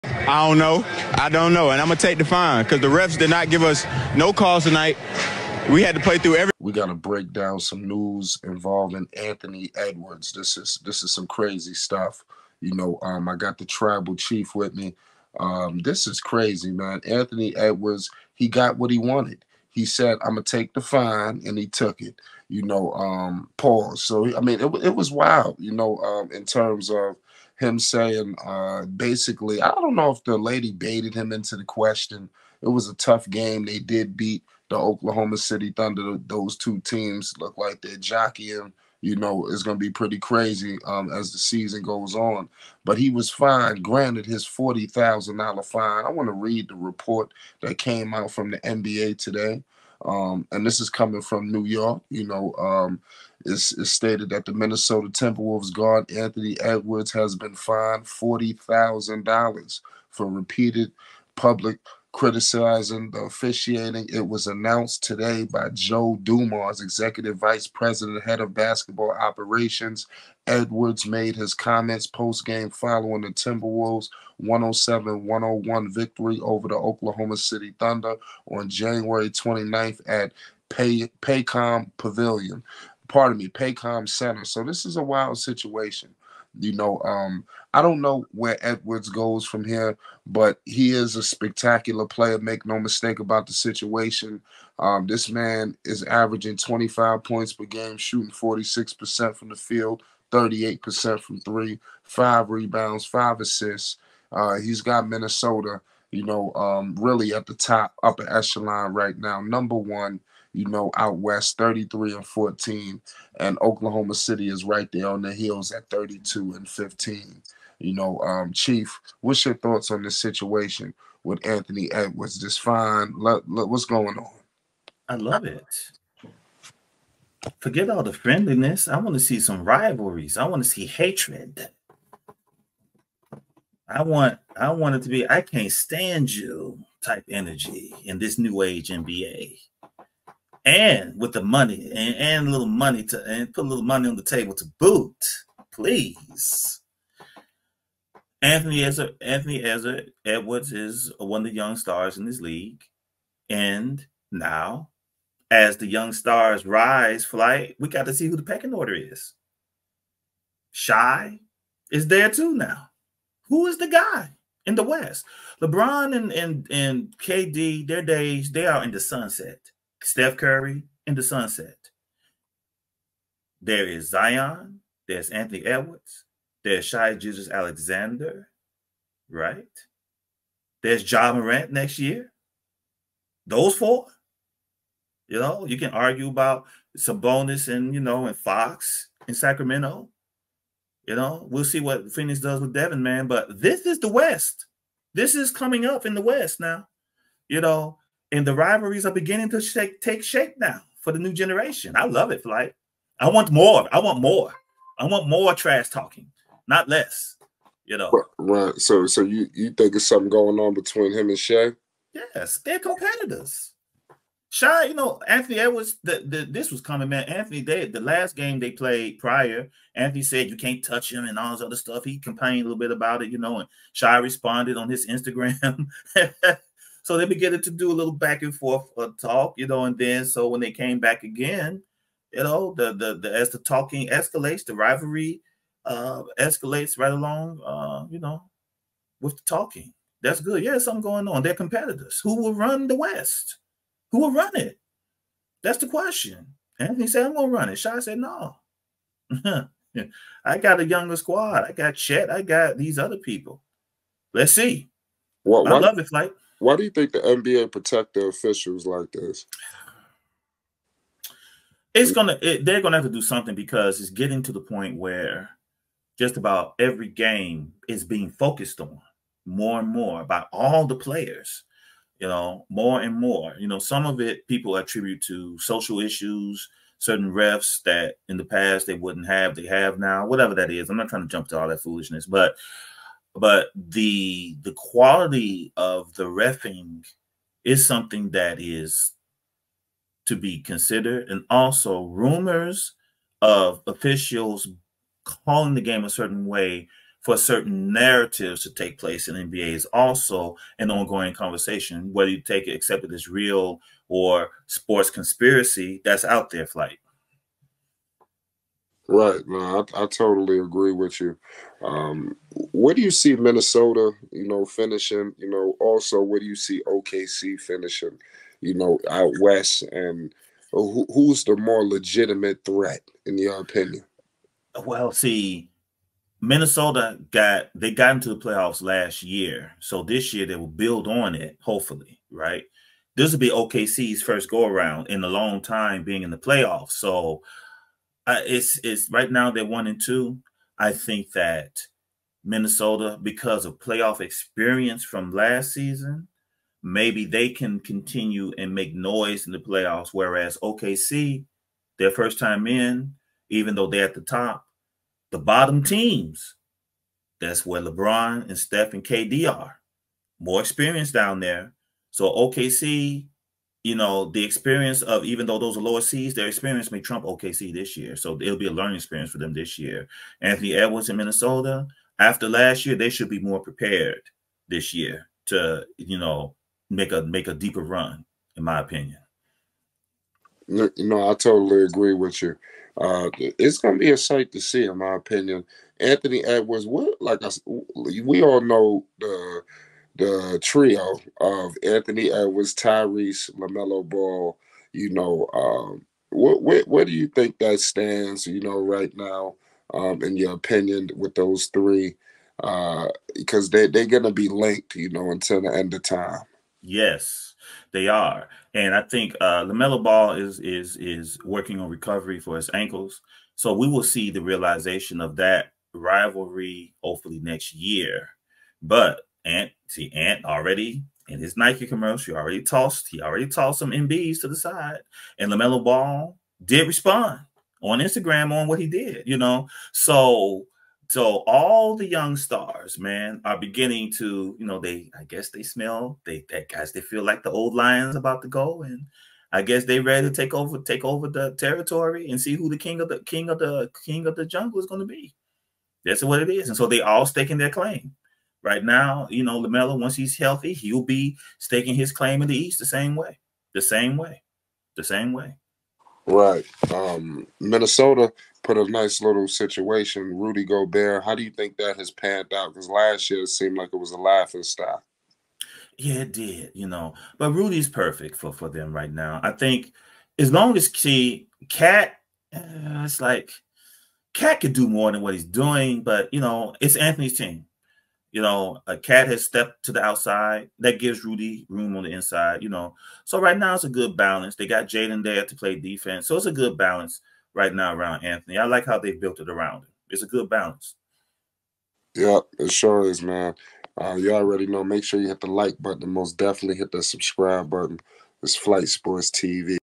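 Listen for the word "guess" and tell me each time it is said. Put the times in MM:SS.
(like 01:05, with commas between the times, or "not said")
07:15, 07:19.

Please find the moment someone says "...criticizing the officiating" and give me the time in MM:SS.
01:02.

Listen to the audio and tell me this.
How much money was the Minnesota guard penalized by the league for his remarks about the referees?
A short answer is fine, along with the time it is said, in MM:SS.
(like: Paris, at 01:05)
$40,000, at 00:58.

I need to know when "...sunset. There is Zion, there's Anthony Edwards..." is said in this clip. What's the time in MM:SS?
02:51.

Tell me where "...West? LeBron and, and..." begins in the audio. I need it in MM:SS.
02:44.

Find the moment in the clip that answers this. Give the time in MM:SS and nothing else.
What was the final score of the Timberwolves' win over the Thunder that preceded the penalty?
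01:14.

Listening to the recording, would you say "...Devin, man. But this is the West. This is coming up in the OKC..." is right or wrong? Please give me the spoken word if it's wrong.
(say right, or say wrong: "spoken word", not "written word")
wrong: "West", not "OKC".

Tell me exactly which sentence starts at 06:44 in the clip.
You know, until the end of time.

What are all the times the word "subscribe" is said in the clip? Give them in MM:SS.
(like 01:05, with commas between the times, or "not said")
08:17.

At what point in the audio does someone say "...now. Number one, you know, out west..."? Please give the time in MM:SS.
01:49.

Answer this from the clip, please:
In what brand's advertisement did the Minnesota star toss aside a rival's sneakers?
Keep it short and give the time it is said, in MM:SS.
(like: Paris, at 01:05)
Nike, at 07:01.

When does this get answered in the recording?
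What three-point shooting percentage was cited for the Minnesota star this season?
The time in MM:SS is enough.
01:40.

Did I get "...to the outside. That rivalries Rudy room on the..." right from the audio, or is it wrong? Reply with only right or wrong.
wrong.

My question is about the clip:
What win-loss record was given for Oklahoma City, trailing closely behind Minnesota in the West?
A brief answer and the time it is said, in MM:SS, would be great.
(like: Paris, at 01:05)
32-15, at 01:55.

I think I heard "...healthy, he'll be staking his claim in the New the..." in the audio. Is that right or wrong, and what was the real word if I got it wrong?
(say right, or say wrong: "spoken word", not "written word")
wrong: "East", not "New".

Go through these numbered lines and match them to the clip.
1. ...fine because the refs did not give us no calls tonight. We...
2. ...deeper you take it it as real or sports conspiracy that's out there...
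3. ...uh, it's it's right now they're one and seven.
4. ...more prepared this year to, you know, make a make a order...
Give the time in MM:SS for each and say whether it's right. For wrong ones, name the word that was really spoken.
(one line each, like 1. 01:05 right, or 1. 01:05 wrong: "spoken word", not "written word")
1. 00:02 right
2. 05:02 wrong: "whether", not "deeper"
3. 05:38 wrong: "two", not "seven"
4. 06:13 wrong: "deeper", not "order".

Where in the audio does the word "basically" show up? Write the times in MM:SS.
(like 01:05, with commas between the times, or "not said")
00:28.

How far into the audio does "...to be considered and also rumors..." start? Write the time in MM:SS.
04:50.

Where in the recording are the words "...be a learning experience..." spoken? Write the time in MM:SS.
06:08.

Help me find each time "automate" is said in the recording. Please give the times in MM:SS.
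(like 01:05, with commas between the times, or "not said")
not said.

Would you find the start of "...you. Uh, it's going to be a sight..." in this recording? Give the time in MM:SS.
06:22.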